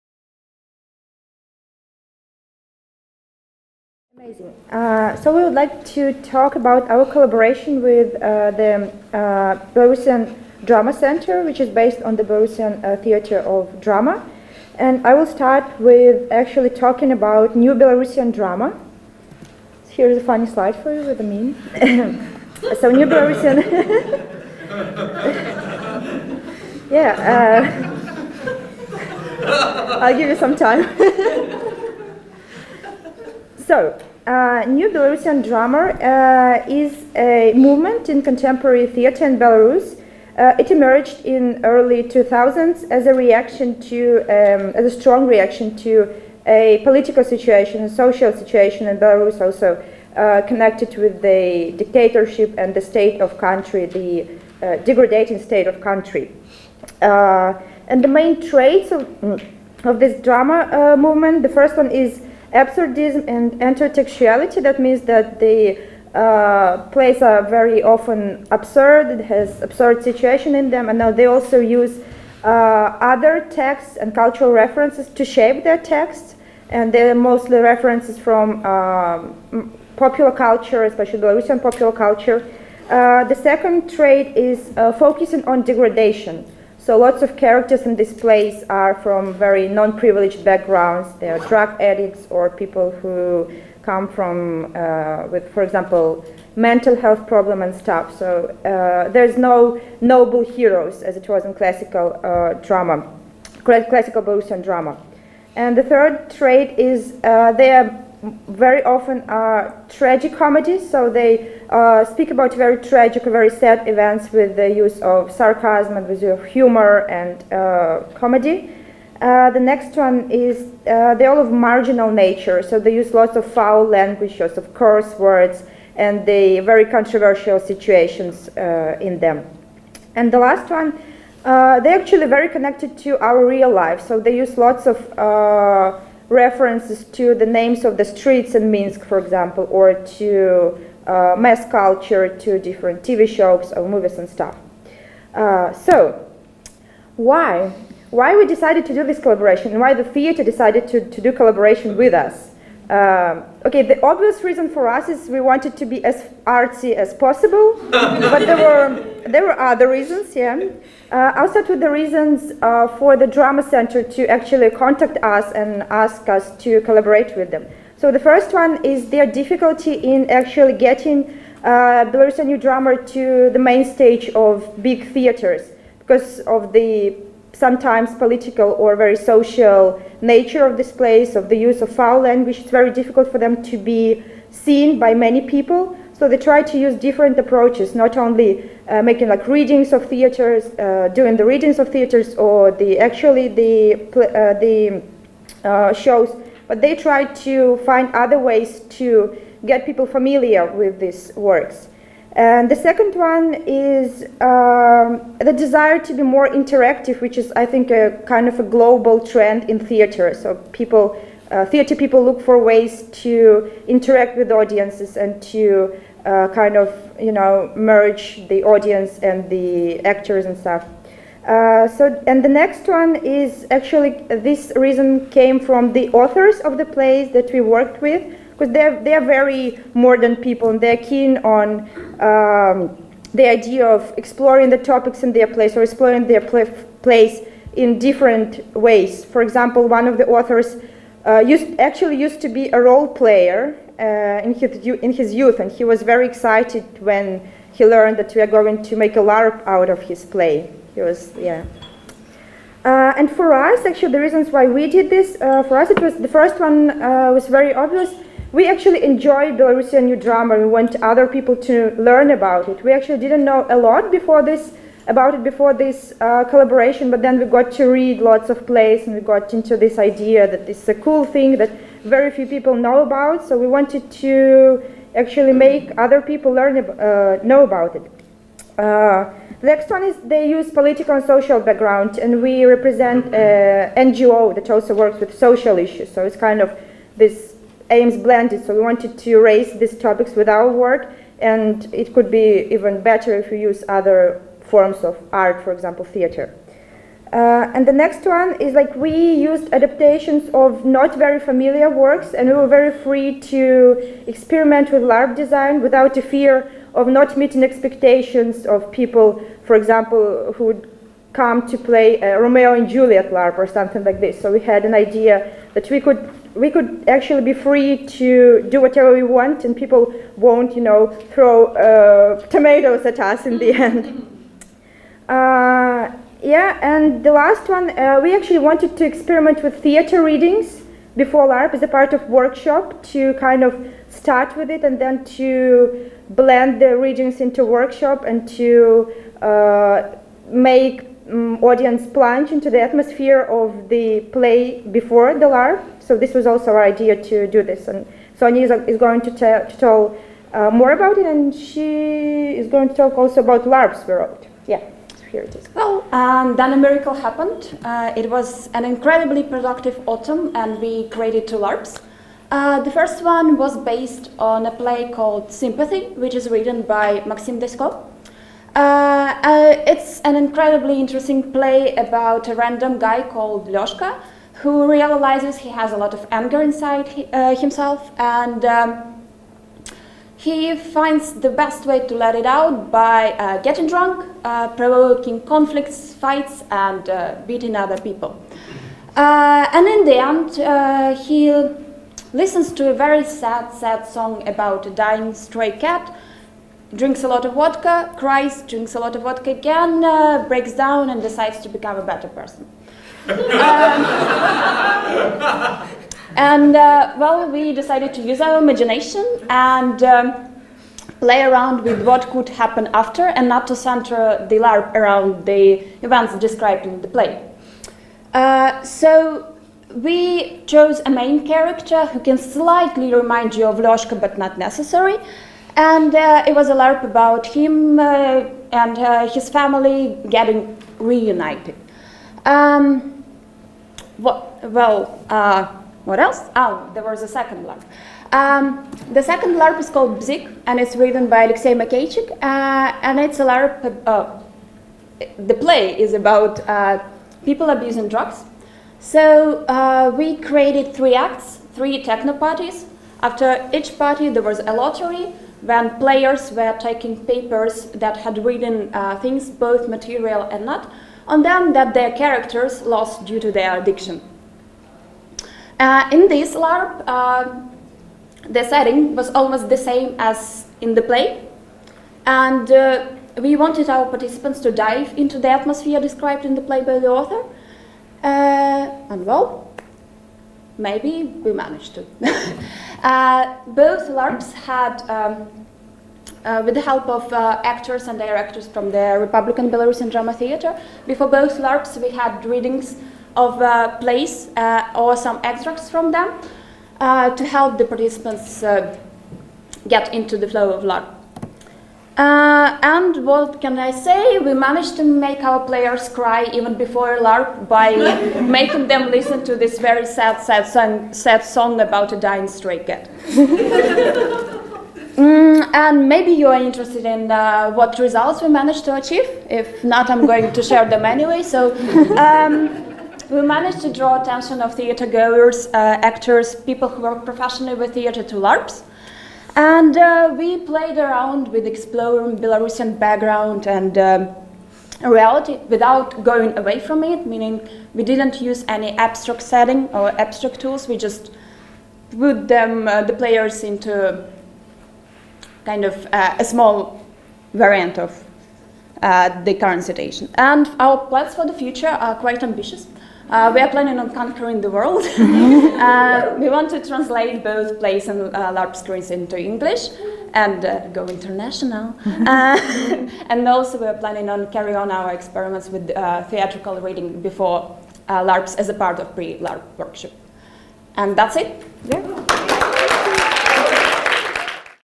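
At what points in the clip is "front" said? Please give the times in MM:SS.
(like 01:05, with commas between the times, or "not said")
not said.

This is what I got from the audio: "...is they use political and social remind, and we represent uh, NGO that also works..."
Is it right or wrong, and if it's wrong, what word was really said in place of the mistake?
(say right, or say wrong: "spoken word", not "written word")
wrong: "background", not "remind".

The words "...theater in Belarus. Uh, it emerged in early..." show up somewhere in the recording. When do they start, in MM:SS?
00:38.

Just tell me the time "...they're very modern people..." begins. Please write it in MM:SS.
03:49.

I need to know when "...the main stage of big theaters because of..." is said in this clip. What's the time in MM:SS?
02:53.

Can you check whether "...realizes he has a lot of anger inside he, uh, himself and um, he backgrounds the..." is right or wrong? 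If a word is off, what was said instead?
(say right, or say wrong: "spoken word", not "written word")
wrong: "finds", not "backgrounds".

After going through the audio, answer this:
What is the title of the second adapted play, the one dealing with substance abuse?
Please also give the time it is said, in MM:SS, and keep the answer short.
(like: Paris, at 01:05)
Bzik, at 07:20.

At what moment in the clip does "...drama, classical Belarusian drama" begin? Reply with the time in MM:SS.
01:42.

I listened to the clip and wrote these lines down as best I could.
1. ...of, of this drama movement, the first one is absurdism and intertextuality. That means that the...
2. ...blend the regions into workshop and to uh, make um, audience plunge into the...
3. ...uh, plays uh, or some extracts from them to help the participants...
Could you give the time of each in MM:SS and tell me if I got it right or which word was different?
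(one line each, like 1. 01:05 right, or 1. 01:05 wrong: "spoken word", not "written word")
1. 00:58 right
2. 05:36 right
3. 08:13 right.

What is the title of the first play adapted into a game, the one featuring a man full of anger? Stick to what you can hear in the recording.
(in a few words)
Sympathy.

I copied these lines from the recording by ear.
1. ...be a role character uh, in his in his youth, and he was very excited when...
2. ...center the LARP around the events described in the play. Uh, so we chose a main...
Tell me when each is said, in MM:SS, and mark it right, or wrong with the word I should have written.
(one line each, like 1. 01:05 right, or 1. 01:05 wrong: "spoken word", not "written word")
1. 04:02 wrong: "player", not "character"
2. 06:53 right.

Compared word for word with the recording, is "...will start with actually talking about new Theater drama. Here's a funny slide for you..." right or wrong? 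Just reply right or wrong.
wrong.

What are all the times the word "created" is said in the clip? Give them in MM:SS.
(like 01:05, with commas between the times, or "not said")
06:01, 07:30.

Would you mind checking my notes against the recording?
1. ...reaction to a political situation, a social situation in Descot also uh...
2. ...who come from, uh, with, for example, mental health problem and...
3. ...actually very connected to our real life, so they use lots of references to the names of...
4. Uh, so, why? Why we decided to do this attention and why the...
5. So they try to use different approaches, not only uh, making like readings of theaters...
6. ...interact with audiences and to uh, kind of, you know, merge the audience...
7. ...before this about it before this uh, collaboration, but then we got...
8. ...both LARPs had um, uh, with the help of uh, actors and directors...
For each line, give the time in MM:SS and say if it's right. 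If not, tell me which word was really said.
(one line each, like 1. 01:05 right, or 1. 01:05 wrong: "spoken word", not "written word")
1. 00:45 wrong: "Belarus", not "Descot"
2. 01:33 right
3. 02:11 right
4. 02:25 wrong: "collaboration", not "attention"
5. 03:06 right
6. 03:33 right
7. 04:24 right
8. 08:03 right.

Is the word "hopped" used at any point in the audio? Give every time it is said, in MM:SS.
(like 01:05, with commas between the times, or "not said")
not said.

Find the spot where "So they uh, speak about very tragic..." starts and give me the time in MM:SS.
01:50.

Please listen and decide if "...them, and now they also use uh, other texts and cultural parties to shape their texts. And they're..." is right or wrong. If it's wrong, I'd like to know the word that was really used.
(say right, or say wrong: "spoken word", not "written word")
wrong: "references", not "parties".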